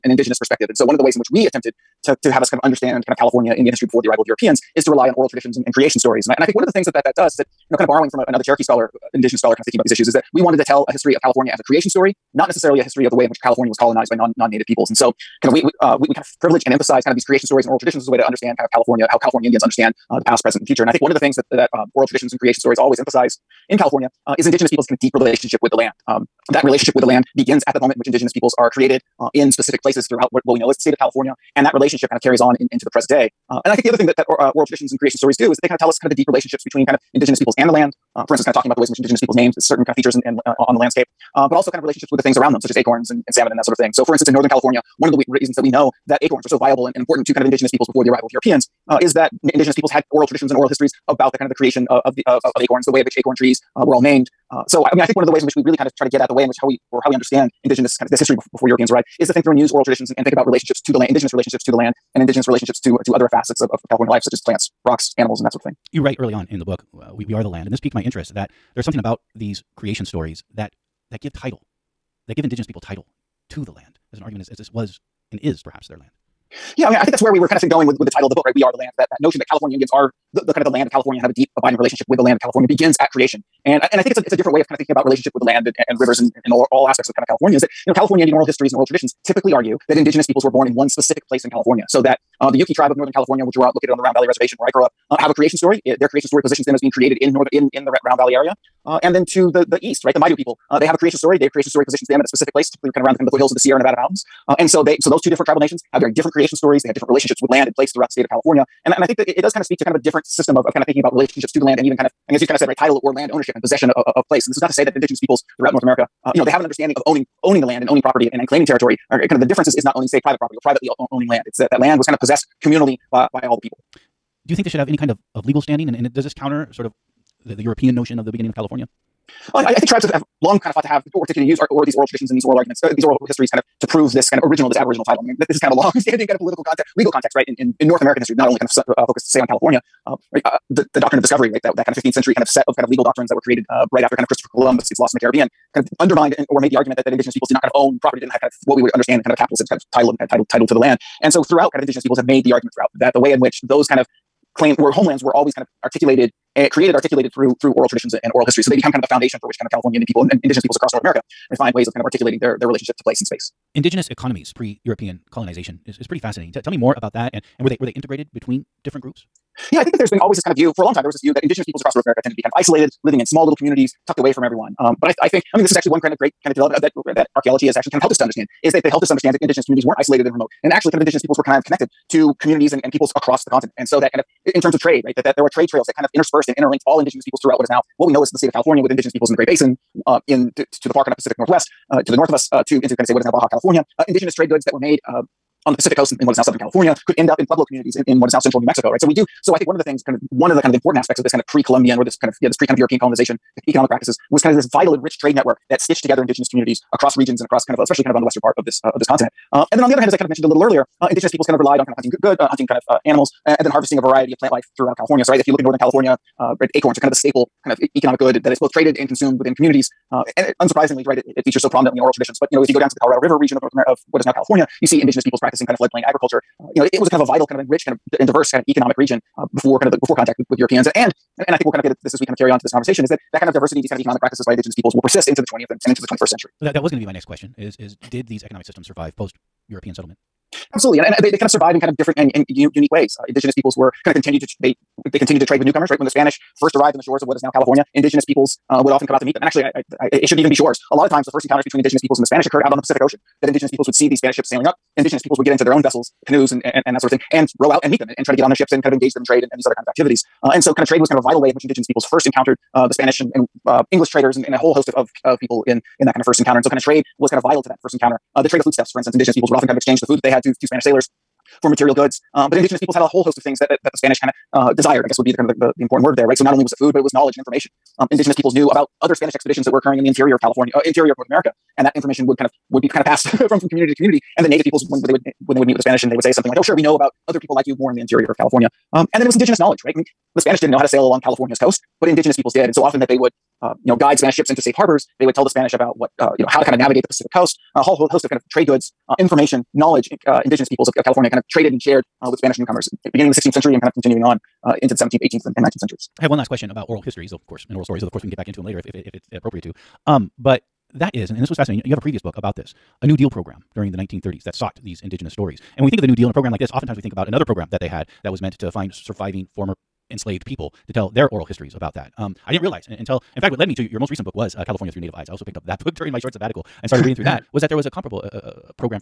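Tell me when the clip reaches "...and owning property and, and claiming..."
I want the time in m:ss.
1:57.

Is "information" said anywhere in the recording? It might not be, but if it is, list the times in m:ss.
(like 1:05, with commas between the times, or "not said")
4:37, 4:41, 4:59.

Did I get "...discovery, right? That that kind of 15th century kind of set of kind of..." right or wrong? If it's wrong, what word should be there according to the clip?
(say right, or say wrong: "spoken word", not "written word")
right.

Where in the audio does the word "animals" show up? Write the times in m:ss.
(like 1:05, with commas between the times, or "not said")
1:05, 3:33.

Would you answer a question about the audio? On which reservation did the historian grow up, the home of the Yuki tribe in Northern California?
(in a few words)
Round Valley Reservation.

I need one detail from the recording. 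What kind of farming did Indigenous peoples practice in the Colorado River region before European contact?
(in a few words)
Floodplain agriculture.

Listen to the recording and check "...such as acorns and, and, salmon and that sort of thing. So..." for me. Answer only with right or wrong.
right.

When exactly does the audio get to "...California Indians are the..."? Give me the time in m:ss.
1:19.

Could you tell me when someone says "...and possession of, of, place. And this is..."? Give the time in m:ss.
1:53.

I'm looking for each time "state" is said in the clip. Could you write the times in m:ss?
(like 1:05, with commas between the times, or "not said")
0:30, 1:48, 3:08.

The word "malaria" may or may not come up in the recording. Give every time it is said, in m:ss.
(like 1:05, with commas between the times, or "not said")
not said.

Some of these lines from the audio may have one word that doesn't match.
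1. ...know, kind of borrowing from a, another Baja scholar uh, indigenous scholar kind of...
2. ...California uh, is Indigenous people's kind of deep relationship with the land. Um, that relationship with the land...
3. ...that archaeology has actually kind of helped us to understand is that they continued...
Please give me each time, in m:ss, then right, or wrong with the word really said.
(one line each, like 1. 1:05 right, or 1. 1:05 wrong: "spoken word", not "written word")
1. 0:07 wrong: "Cherokee", not "Baja"
2. 0:23 right
3. 2:57 wrong: "helped", not "continued".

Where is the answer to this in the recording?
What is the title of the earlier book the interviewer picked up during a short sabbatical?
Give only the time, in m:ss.
5:24.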